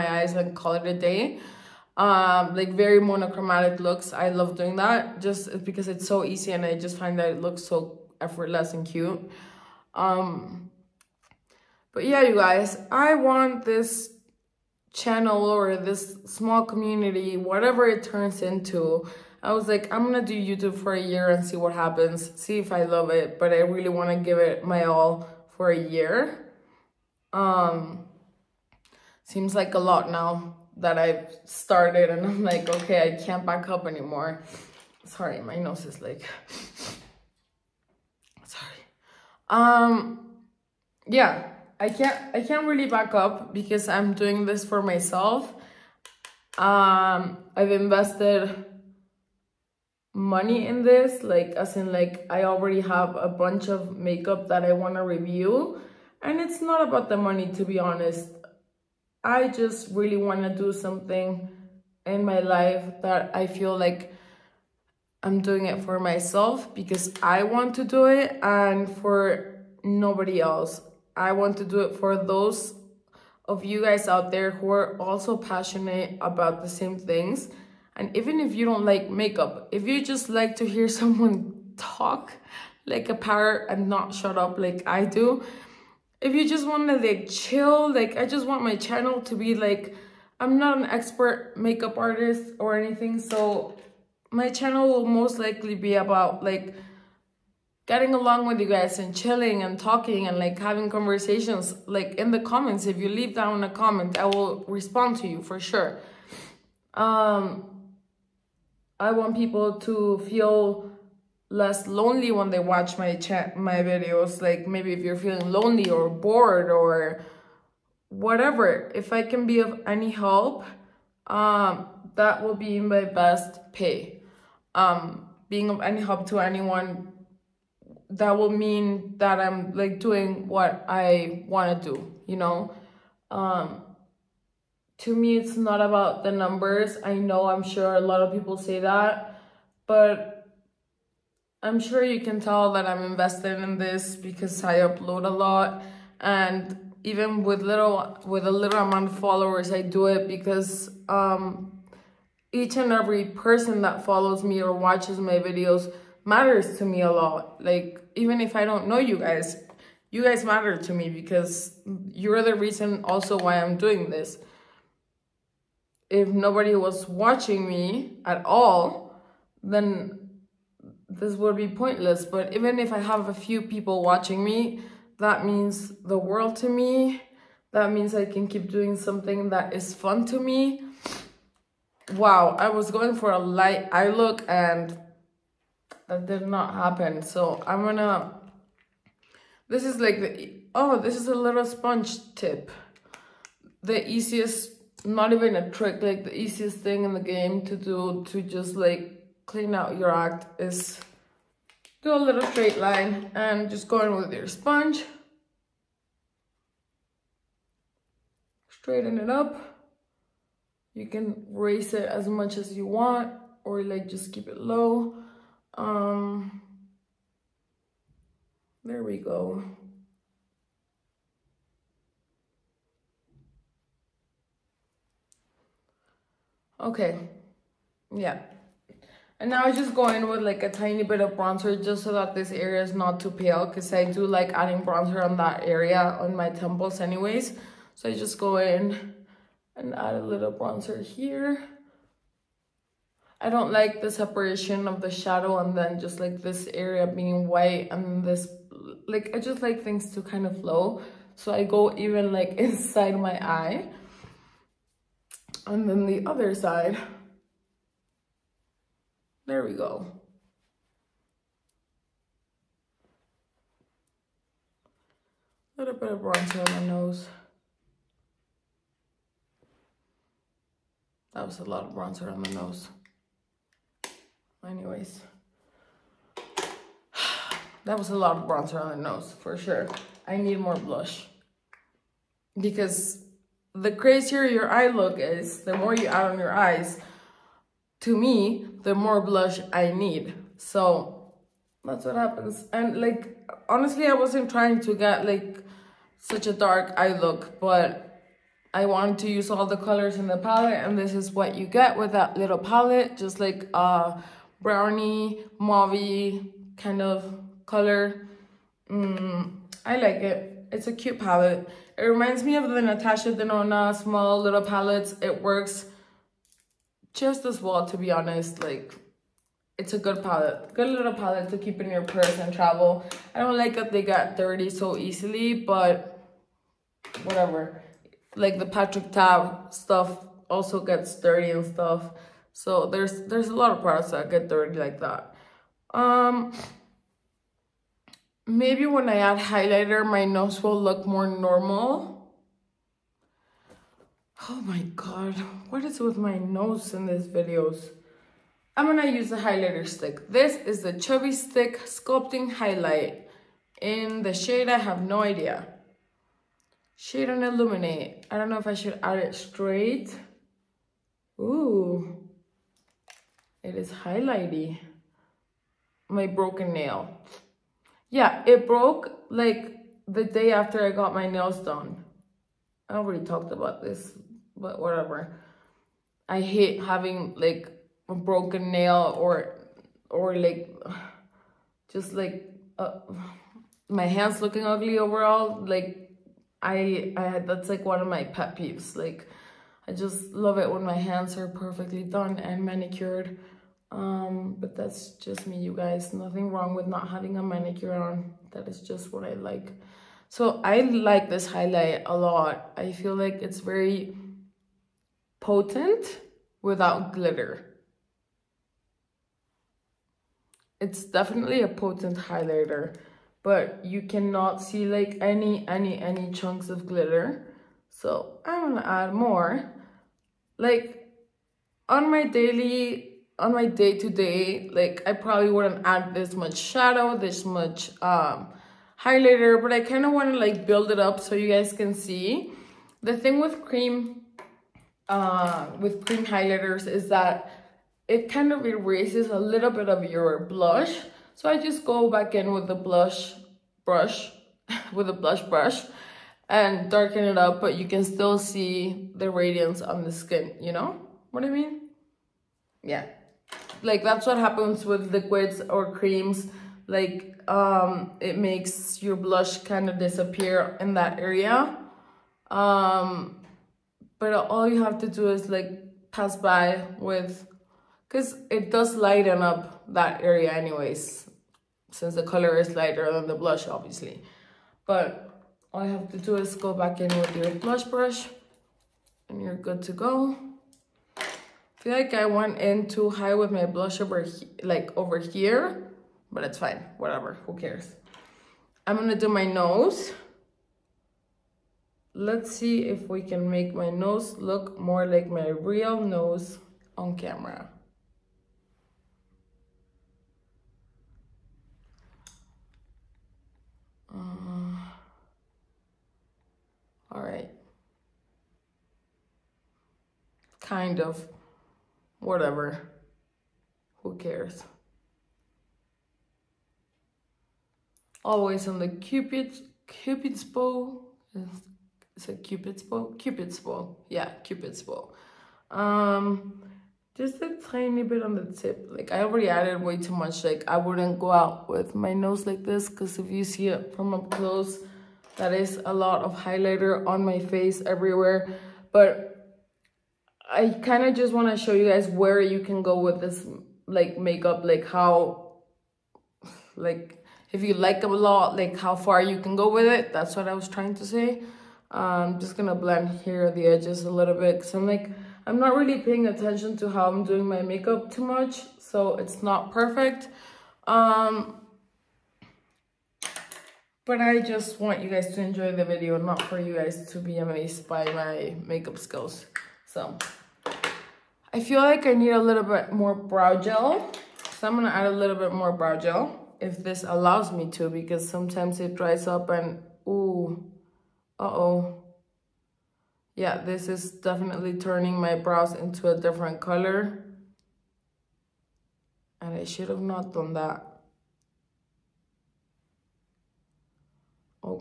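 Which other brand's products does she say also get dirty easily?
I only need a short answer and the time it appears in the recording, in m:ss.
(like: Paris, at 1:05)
Patrick Ta, at 5:28.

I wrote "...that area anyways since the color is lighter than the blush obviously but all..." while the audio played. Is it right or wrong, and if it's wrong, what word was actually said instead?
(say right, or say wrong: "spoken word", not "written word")
right.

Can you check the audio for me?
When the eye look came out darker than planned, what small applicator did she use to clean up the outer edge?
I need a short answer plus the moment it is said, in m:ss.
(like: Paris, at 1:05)
sponge tip, at 3:11.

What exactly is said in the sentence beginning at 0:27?
Um, seems like a lot now that I've started and I'm like, okay, I can't back up anymore.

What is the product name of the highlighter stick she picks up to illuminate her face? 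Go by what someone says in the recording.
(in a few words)
Chubby Stick Sculpting Highlight.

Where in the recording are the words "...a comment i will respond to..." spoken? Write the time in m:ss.
1:43.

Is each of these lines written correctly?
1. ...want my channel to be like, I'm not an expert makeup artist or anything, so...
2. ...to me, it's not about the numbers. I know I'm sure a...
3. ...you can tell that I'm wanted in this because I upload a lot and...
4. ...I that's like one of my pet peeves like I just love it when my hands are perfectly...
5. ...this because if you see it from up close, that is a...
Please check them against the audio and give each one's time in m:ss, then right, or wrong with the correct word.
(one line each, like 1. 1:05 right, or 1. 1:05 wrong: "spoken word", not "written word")
1. 1:28 right
2. 2:14 right
3. 2:22 wrong: "invested", not "wanted"
4. 6:27 right
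5. 8:52 right.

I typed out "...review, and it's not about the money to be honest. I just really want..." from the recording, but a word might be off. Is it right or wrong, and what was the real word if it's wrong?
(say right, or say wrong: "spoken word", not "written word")
right.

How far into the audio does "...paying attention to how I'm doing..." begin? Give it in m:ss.
9:16.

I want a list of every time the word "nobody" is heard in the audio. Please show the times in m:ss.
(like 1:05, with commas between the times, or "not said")
1:09, 2:46.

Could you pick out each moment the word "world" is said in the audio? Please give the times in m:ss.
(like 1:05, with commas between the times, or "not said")
2:56.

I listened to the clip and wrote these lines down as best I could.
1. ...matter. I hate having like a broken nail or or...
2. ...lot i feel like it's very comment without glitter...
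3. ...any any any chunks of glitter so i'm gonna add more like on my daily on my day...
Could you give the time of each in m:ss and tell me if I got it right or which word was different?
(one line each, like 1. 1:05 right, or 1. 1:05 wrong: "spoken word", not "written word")
1. 6:14 wrong: "whatever", not "matter"
2. 6:42 wrong: "potent", not "comment"
3. 6:55 right.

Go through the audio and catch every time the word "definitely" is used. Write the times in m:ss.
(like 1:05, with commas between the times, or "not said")
6:51, 9:44.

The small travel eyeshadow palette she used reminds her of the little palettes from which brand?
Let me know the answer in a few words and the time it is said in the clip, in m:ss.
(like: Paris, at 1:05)
Natasha Denona, at 5:12.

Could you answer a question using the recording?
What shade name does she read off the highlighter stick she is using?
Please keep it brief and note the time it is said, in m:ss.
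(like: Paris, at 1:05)
Shade and Illuminate, at 5:56.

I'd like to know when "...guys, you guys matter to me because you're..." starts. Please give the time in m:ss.
2:39.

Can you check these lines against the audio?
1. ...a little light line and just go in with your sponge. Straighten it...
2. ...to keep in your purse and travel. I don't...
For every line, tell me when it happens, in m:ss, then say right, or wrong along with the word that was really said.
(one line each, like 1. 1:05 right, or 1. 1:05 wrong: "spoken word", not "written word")
1. 3:22 wrong: "straight", not "light"
2. 5:21 right.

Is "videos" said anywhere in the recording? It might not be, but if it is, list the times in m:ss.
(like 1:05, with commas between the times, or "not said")
1:53, 2:35, 5:47, 9:25.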